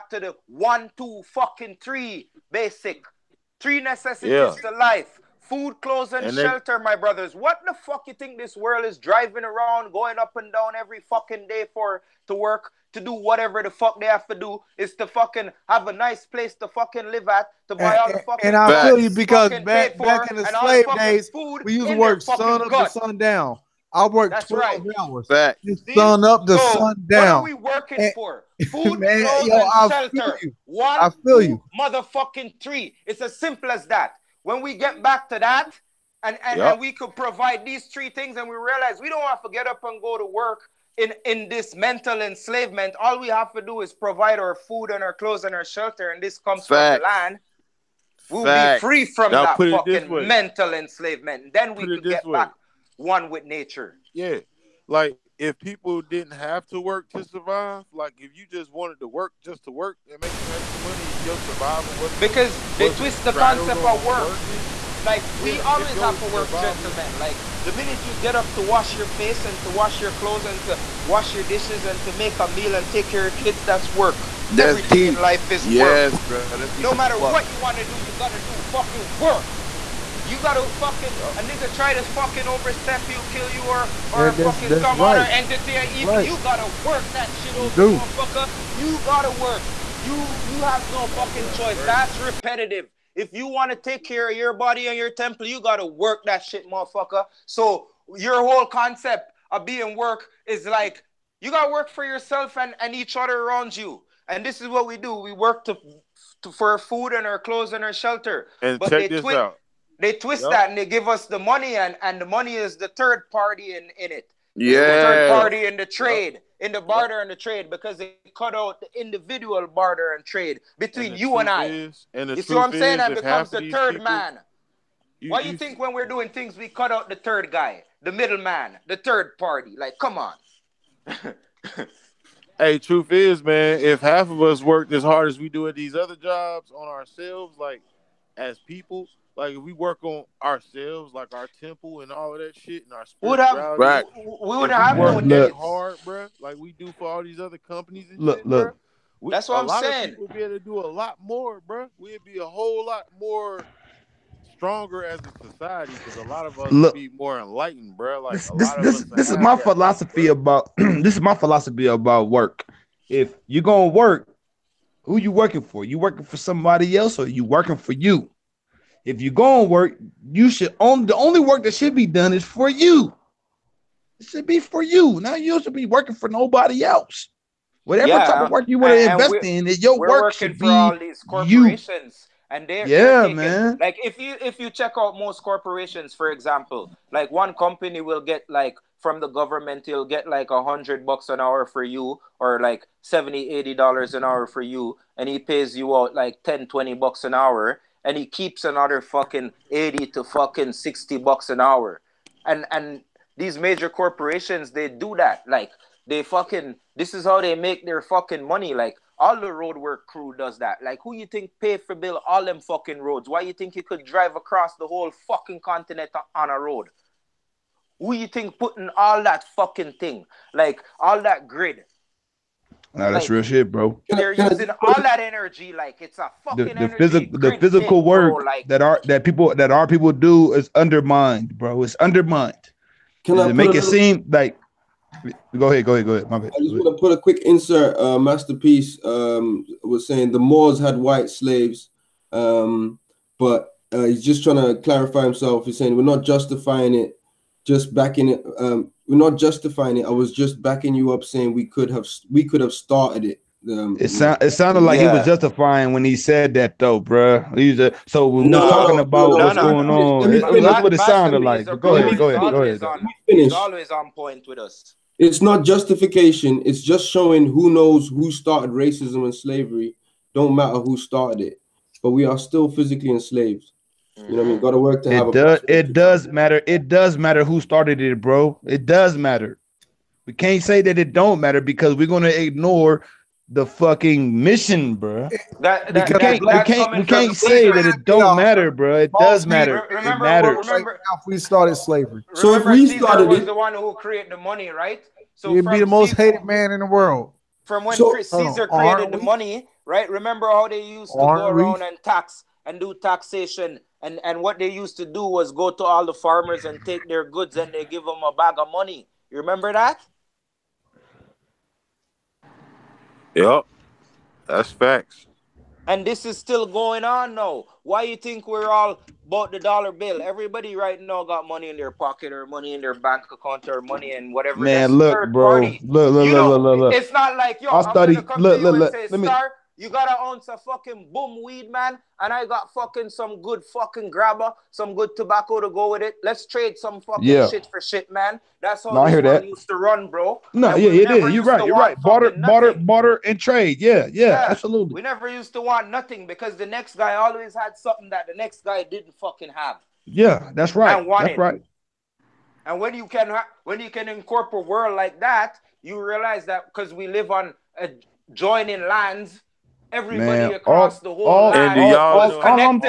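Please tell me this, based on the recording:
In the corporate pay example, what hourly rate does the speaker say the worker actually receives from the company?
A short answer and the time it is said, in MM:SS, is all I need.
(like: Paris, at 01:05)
$10 to $20, at 03:16.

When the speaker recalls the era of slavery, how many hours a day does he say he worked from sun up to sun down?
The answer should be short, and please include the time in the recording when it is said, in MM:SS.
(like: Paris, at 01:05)
12, at 00:24.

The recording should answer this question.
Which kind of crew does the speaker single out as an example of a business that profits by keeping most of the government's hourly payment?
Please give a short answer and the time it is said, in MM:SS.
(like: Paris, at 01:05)
Road work crew, at 03:29.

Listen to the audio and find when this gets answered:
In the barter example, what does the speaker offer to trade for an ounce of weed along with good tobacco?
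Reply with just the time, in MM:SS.
05:34.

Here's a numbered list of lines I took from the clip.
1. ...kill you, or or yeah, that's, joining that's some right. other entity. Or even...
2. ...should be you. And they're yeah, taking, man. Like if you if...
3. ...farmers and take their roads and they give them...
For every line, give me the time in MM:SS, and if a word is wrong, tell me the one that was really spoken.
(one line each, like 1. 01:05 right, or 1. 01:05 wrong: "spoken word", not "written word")
1. 01:23 wrong: "fucking", not "joining"
2. 03:00 right
3. 05:06 wrong: "goods", not "roads".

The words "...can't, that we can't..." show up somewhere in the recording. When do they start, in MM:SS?
04:46.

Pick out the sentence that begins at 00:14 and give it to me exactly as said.
Is to fucking have a nice place to fucking live at, to buy and, all the fucking.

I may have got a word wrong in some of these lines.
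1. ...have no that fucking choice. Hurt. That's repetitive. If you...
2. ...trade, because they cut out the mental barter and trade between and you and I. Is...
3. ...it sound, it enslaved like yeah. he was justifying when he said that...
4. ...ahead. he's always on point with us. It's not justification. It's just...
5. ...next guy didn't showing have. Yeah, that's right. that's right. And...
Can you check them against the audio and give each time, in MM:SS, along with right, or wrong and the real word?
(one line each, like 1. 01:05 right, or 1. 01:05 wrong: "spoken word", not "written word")
1. 01:30 right
2. 01:57 wrong: "individual", not "mental"
3. 04:13 wrong: "sounded", not "enslaved"
4. 04:22 right
5. 05:48 wrong: "fucking", not "showing".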